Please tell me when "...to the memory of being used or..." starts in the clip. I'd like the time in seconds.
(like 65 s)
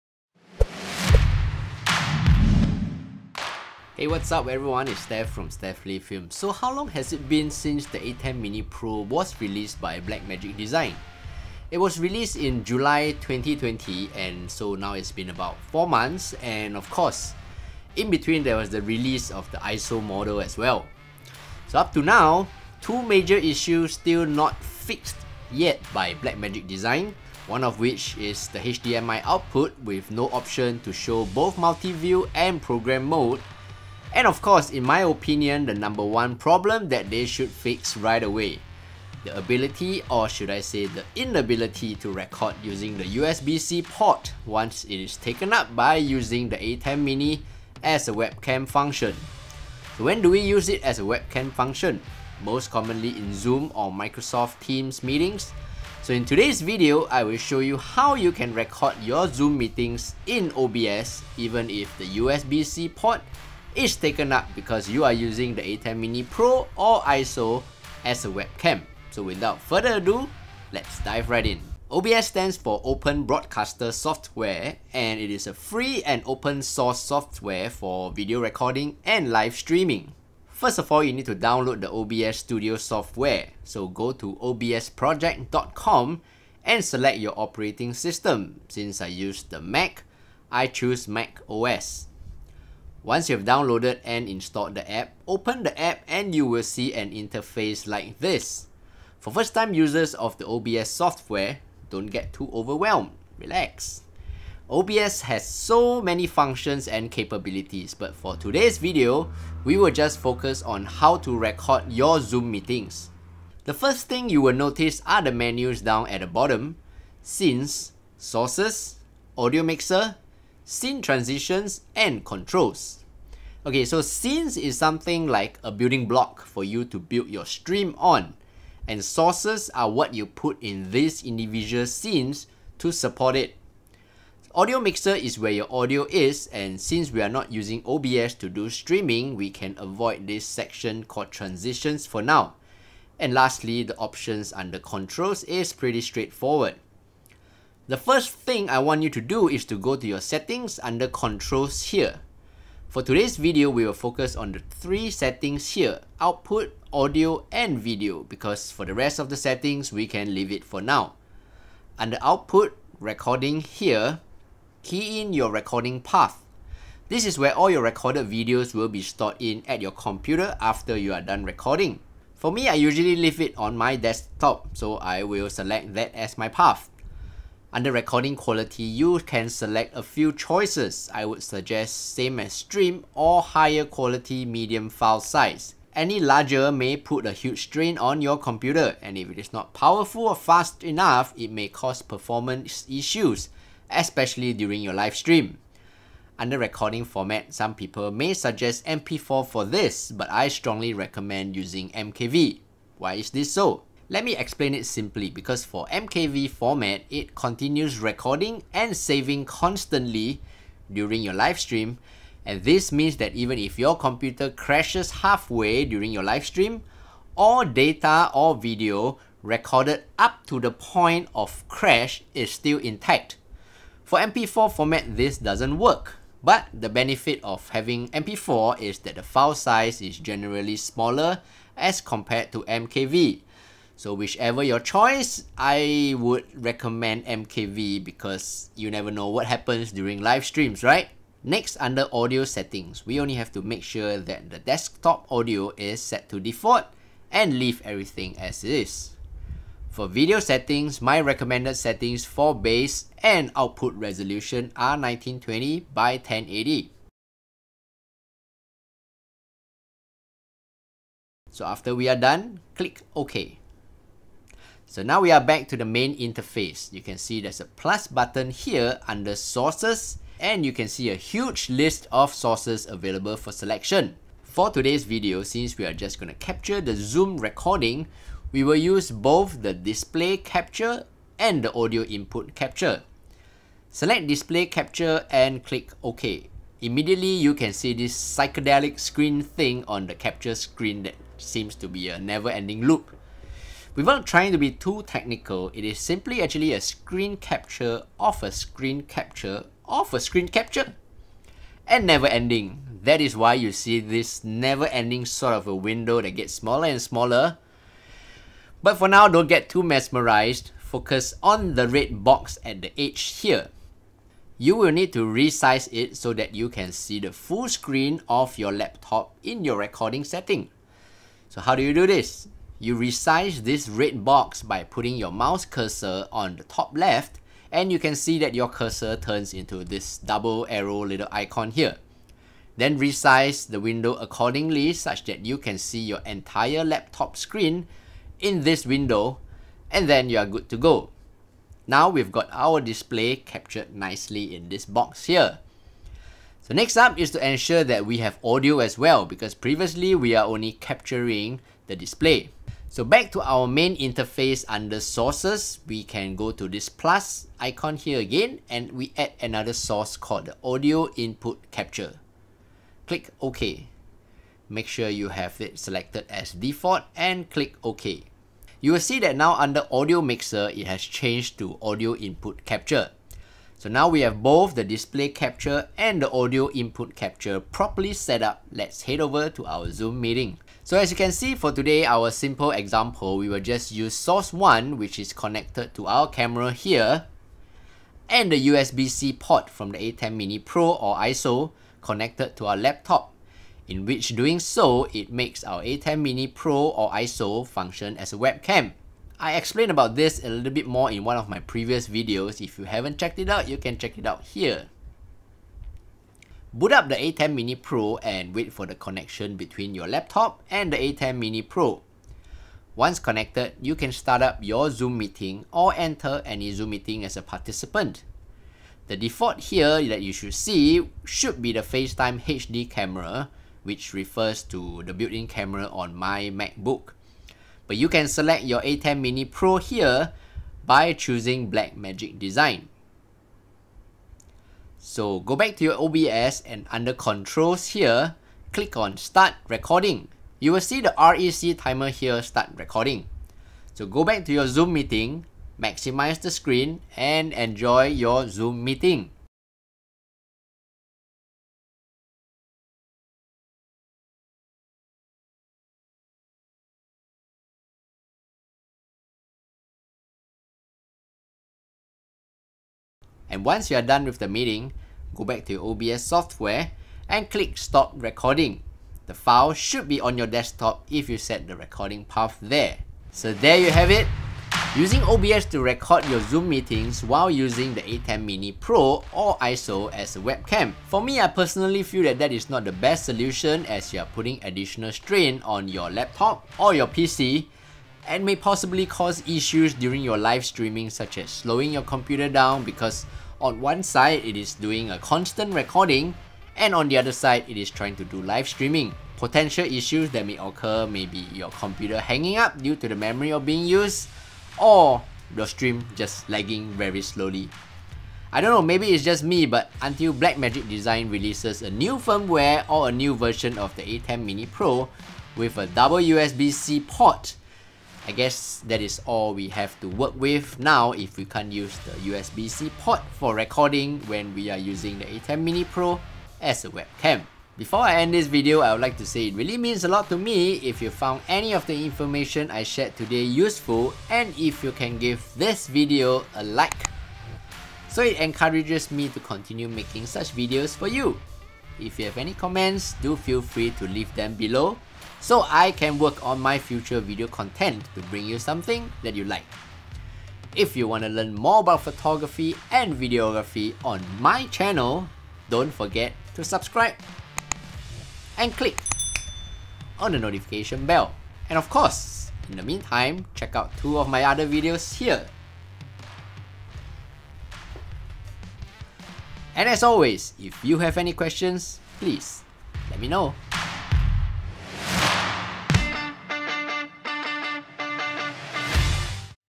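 502 s.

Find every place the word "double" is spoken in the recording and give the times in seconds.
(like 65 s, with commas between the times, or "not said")
330 s, 515 s.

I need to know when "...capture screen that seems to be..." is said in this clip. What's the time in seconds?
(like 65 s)
290 s.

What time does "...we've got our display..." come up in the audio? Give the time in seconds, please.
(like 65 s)
342 s.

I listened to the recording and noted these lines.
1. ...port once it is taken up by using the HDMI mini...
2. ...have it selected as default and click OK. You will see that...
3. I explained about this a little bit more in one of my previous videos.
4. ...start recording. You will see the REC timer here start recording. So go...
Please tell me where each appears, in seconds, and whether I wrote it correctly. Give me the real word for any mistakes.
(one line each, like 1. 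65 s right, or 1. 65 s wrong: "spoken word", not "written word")
1. 43 s wrong: "ATEM", not "HDMI"
2. 365 s right
3. 399 s right
4. 439 s right.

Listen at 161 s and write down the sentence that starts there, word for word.
Under output, recording here, key in your recording path.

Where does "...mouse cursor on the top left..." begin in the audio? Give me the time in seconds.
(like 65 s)
325 s.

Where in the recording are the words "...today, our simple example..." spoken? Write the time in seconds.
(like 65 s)
381 s.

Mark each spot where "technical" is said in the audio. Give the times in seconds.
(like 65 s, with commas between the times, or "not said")
295 s.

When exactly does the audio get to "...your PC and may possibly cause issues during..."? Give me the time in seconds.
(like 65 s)
486 s.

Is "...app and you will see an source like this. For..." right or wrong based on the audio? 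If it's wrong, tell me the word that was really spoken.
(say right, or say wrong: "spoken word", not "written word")
wrong: "interface", not "source".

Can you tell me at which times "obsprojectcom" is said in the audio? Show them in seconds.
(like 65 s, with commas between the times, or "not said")
84 s.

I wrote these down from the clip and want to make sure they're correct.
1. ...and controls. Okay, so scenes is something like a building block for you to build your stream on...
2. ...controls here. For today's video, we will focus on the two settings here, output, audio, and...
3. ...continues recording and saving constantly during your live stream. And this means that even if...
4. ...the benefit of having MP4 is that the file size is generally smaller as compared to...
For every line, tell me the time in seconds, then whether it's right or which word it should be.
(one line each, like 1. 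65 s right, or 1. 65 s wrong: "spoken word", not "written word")
1. 121 s right
2. 151 s wrong: "three", not "two"
3. 207 s right
4. 226 s right.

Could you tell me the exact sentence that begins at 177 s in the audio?
Under recording quality, you can select a few choices.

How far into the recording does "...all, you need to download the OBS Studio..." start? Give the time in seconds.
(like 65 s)
80 s.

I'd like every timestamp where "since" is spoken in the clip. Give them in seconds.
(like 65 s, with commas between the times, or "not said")
7 s, 88 s, 136 s, 275 s.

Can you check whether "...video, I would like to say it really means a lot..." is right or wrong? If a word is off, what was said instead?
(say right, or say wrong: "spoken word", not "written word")
right.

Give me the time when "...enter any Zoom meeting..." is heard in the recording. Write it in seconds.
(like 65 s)
415 s.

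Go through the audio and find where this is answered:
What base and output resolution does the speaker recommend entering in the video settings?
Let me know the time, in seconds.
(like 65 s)
254 s.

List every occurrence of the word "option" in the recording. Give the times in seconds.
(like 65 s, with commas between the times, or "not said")
30 s, 143 s.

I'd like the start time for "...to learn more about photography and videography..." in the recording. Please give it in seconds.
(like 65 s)
551 s.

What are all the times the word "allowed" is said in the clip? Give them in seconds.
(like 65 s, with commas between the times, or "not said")
not said.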